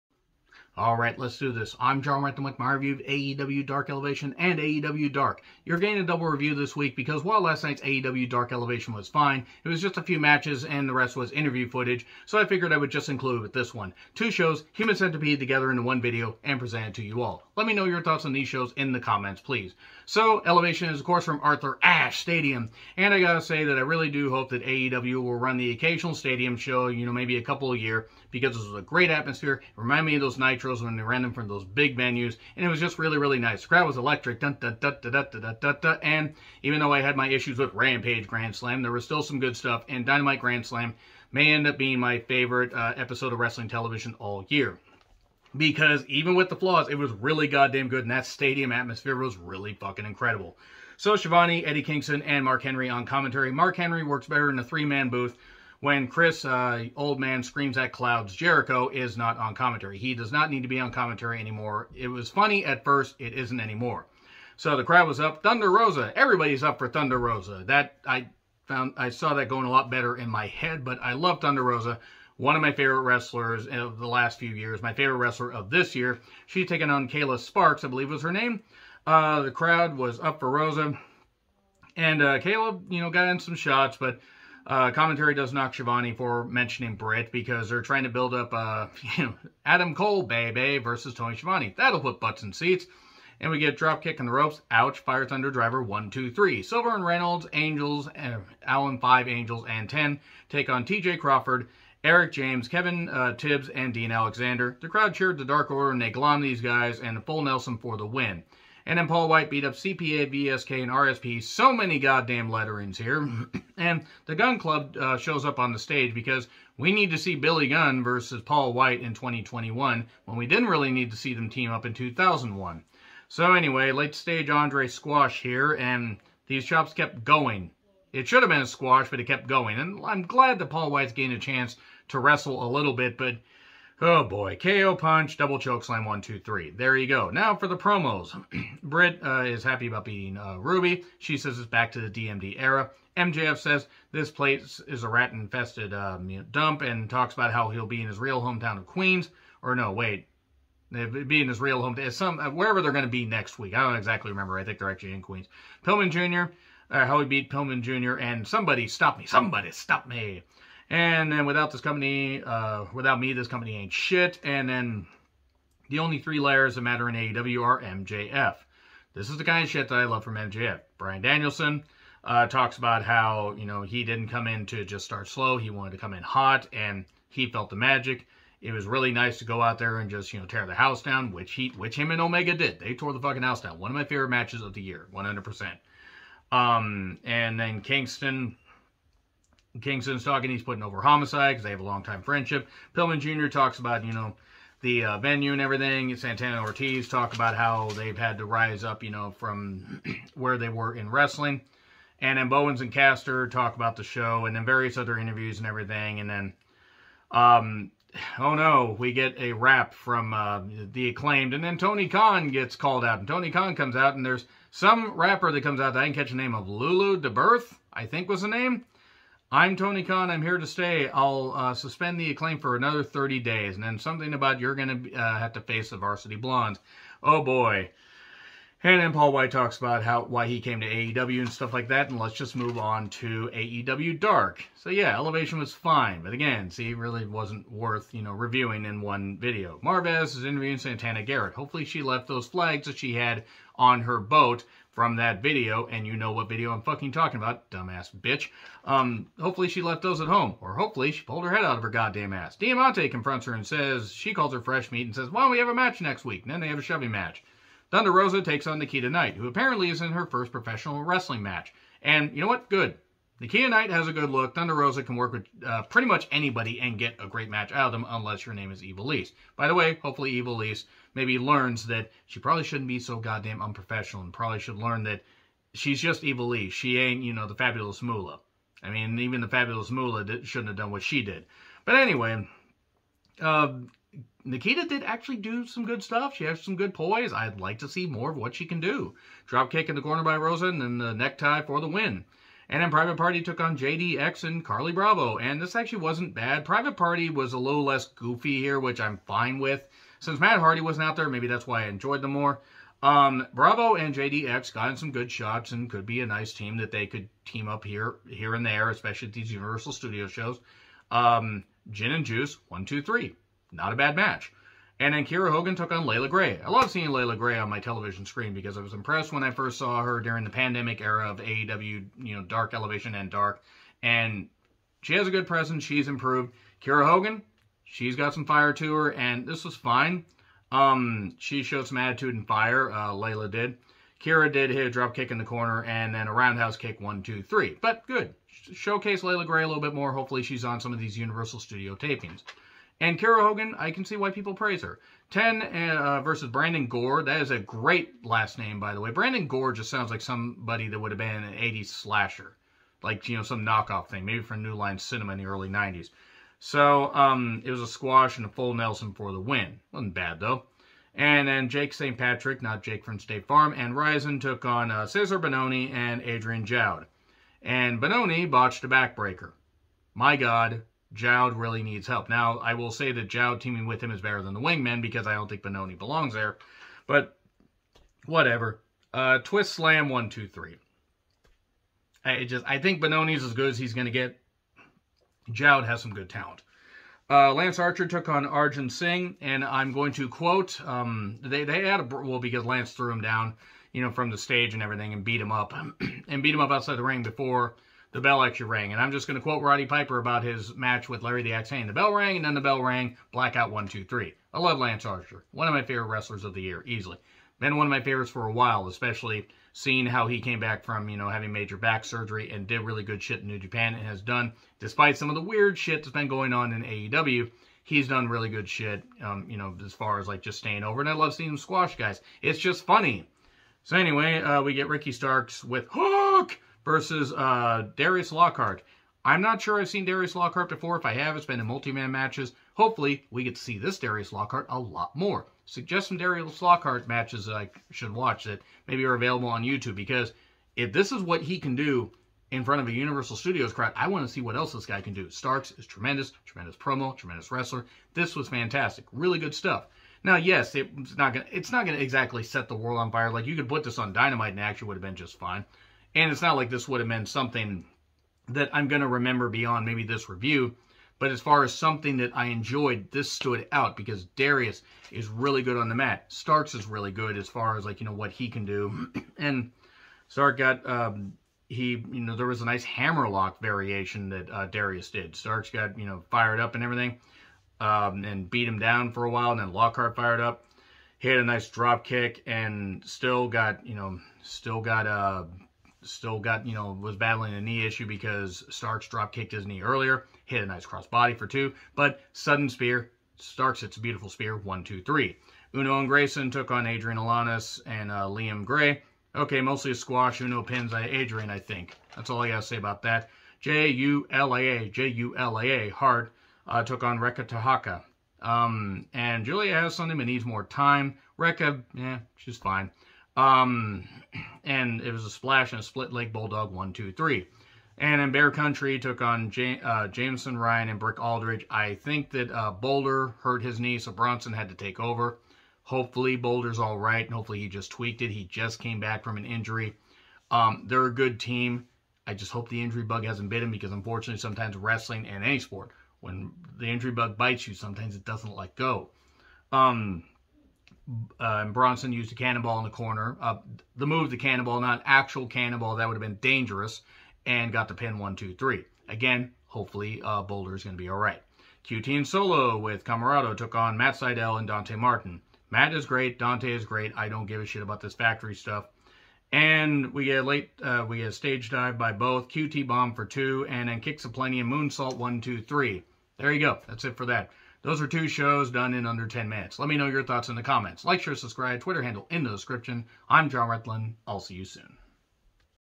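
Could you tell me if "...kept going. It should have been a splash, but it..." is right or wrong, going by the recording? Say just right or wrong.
wrong.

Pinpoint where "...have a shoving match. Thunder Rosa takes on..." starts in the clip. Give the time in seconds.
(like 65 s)
256 s.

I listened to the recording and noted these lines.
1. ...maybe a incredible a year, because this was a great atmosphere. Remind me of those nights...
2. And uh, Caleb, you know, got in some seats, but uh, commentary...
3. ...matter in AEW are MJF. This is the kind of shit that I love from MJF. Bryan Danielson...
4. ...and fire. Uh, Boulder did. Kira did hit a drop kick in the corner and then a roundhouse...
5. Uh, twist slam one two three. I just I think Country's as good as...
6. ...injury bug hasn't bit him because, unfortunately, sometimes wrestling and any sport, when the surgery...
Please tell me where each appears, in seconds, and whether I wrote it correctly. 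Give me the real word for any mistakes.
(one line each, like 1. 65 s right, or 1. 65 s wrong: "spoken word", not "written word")
1. 27 s wrong: "couple", not "incredible"
2. 81 s wrong: "shots", not "seats"
3. 166 s right
4. 332 s wrong: "Layla", not "Boulder"
5. 379 s wrong: "Benoni", not "Country"
6. 532 s wrong: "injury", not "surgery".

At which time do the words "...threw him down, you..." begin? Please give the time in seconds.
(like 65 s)
392 s.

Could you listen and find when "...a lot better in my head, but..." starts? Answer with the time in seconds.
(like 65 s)
69 s.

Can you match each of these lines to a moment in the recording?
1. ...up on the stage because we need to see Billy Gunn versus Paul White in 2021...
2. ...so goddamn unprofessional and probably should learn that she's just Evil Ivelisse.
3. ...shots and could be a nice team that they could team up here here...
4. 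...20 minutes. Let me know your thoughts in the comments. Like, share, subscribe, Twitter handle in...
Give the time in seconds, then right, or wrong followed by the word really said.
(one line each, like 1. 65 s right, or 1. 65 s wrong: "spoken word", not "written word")
1. 115 s right
2. 272 s right
3. 305 s right
4. 569 s wrong: "10", not "20".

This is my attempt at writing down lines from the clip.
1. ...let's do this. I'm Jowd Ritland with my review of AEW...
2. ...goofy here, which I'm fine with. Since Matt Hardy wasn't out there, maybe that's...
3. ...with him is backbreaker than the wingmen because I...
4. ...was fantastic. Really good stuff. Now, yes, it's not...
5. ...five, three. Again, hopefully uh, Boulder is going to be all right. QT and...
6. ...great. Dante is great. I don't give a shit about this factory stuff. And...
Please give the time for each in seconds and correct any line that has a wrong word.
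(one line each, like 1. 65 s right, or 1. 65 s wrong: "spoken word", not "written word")
1. 1 s wrong: "Jonn", not "Jowd"
2. 298 s right
3. 373 s wrong: "better", not "backbreaker"
4. 448 s right
5. 548 s wrong: "two", not "five"
6. 556 s right.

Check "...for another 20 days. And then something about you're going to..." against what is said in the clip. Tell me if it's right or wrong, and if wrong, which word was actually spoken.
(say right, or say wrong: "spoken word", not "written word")
wrong: "30", not "20".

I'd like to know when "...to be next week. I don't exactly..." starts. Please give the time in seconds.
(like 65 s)
153 s.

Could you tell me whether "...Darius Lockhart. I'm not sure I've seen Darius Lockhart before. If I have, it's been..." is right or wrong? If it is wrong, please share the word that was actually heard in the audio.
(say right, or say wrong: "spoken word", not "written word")
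right.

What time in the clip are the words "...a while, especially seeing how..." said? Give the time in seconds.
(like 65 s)
408 s.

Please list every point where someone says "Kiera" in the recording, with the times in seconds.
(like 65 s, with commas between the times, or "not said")
315 s, 326 s, 343 s.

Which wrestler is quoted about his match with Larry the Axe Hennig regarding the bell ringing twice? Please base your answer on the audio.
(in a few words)
Roddy Piper.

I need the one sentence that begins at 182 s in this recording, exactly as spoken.
They tore the fucking house down.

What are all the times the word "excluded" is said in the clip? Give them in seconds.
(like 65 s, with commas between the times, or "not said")
not said.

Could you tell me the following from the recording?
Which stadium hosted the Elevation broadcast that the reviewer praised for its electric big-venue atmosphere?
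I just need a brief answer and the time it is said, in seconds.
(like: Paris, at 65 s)
Arthur Ashe Stadium, at 21 s.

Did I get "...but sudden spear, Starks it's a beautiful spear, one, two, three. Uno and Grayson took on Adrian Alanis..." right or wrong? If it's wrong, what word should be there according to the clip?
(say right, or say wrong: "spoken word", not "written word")
right.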